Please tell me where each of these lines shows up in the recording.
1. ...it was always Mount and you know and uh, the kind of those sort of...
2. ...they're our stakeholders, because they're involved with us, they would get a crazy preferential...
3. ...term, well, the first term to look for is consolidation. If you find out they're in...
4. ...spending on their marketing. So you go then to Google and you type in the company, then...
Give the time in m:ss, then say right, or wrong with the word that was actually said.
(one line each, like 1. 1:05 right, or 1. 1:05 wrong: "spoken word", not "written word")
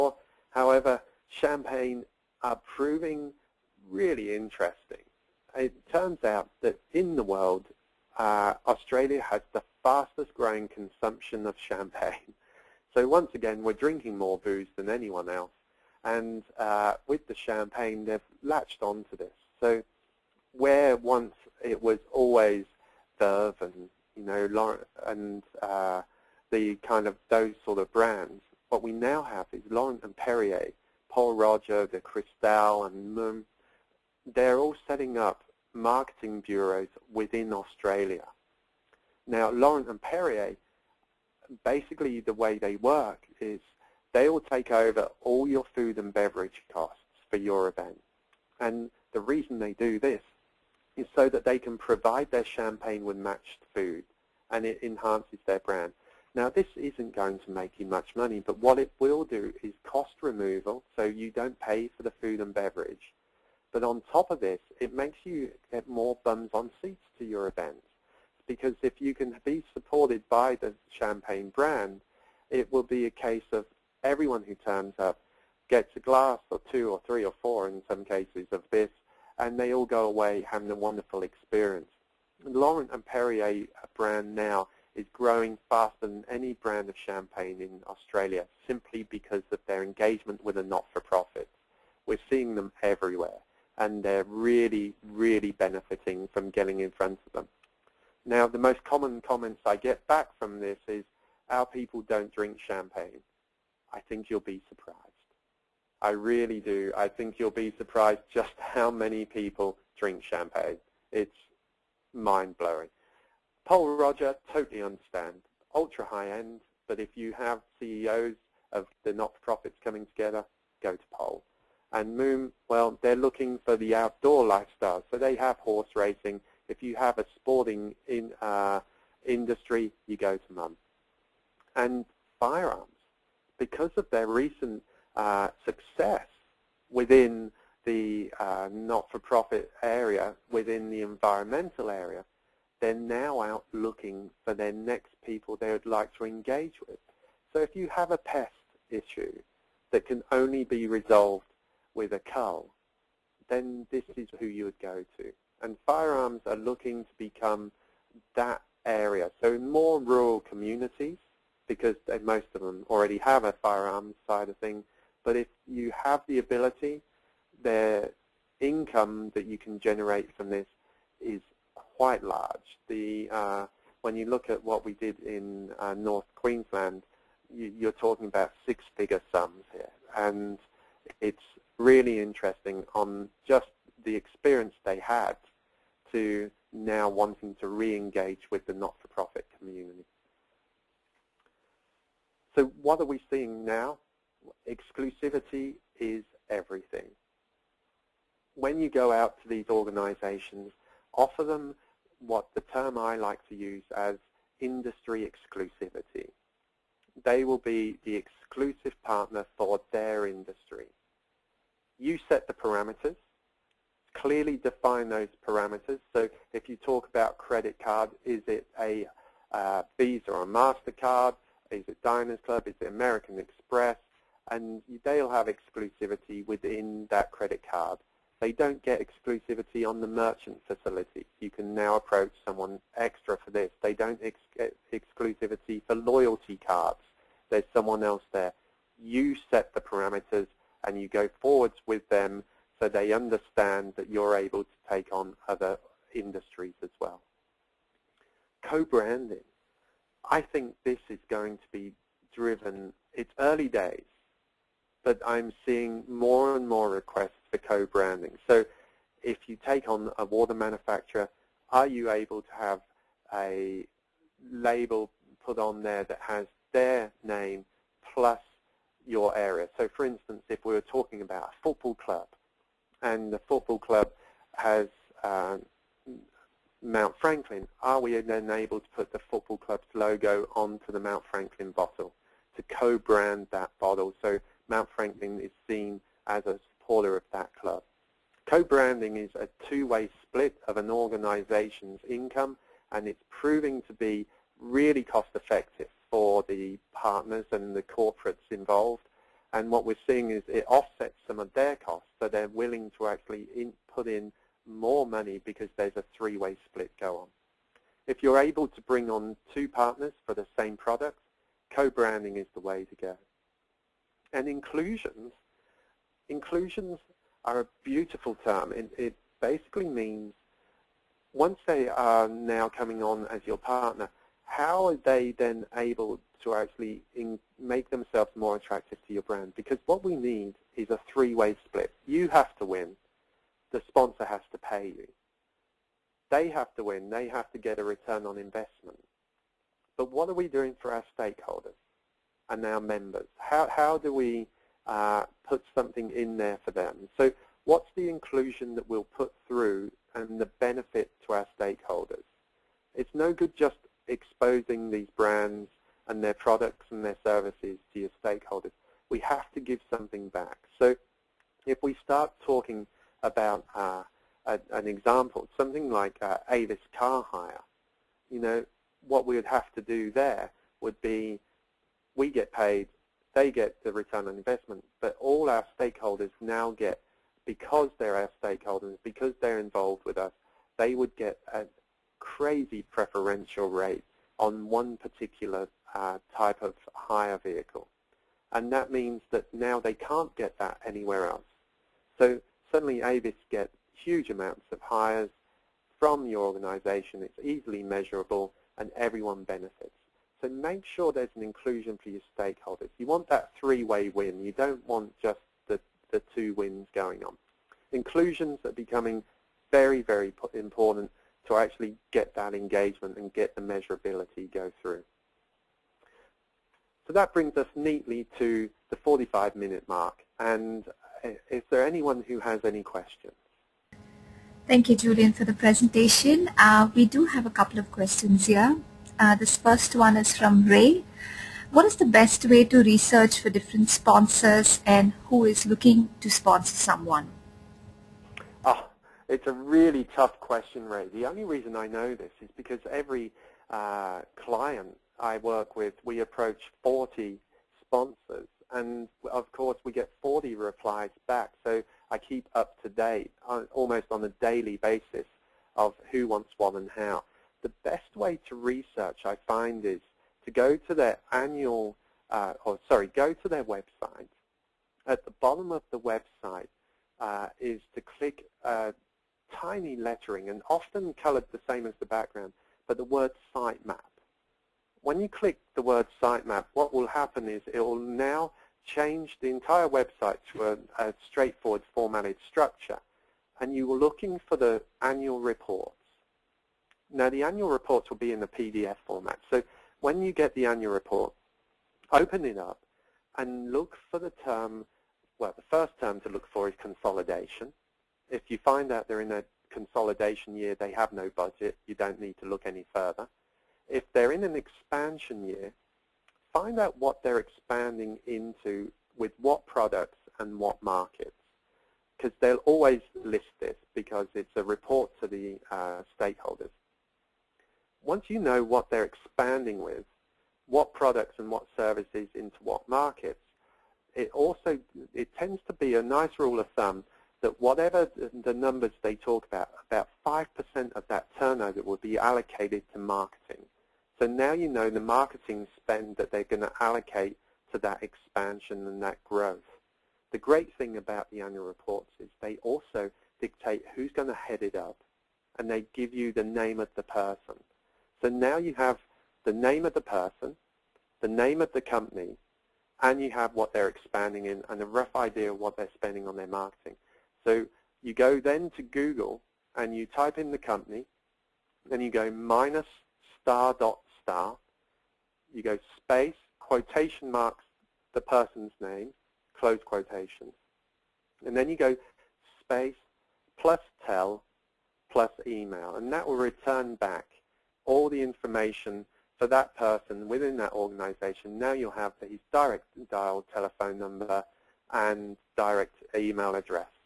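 1. 0:21 wrong: "Veuve", not "Mount"
2. 6:17 right
3. 8:14 right
4. 9:15 right.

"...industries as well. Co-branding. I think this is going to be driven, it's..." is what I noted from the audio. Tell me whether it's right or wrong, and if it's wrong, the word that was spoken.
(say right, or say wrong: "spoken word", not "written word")
right.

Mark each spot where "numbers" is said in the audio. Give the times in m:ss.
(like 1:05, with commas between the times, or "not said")
8:48, 9:43.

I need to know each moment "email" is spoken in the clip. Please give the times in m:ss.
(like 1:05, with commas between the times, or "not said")
9:35, 9:46.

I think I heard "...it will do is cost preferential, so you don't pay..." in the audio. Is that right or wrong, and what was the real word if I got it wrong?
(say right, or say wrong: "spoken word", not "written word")
wrong: "removal", not "preferential".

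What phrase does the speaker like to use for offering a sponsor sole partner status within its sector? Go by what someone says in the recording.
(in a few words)
industry exclusivity.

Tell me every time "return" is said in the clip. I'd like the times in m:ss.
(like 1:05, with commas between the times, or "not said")
5:37, 6:13, 9:36.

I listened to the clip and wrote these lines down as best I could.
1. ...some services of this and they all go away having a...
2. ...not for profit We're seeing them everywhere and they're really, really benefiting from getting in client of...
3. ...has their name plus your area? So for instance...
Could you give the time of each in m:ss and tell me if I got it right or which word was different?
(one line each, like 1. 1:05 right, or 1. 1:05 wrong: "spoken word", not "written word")
1. 1:17 wrong: "cases", not "services"
2. 1:30 wrong: "front", not "client"
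3. 4:26 right.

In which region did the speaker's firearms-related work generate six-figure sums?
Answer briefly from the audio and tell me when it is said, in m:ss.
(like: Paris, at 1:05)
North Queensland, at 2:55.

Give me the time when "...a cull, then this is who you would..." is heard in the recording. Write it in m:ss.
2:32.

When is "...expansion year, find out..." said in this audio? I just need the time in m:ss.
8:24.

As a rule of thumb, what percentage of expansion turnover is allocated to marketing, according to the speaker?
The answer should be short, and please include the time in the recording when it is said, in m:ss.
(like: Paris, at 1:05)
5%, at 8:50.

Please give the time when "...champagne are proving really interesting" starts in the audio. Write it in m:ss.
0:01.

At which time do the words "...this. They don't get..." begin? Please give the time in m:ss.
3:53.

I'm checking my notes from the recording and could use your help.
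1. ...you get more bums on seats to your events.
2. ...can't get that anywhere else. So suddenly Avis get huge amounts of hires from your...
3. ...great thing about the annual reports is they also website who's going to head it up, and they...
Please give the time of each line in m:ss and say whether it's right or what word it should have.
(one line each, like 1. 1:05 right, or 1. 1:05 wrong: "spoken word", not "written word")
1. 1:05 right
2. 6:29 right
3. 9:00 wrong: "dictate", not "website".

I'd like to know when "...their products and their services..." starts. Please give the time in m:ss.
5:56.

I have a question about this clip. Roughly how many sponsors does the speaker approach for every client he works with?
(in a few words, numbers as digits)
40.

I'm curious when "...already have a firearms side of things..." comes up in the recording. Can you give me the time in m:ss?
2:42.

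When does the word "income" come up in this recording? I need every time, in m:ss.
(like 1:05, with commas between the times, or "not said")
2:48, 4:52.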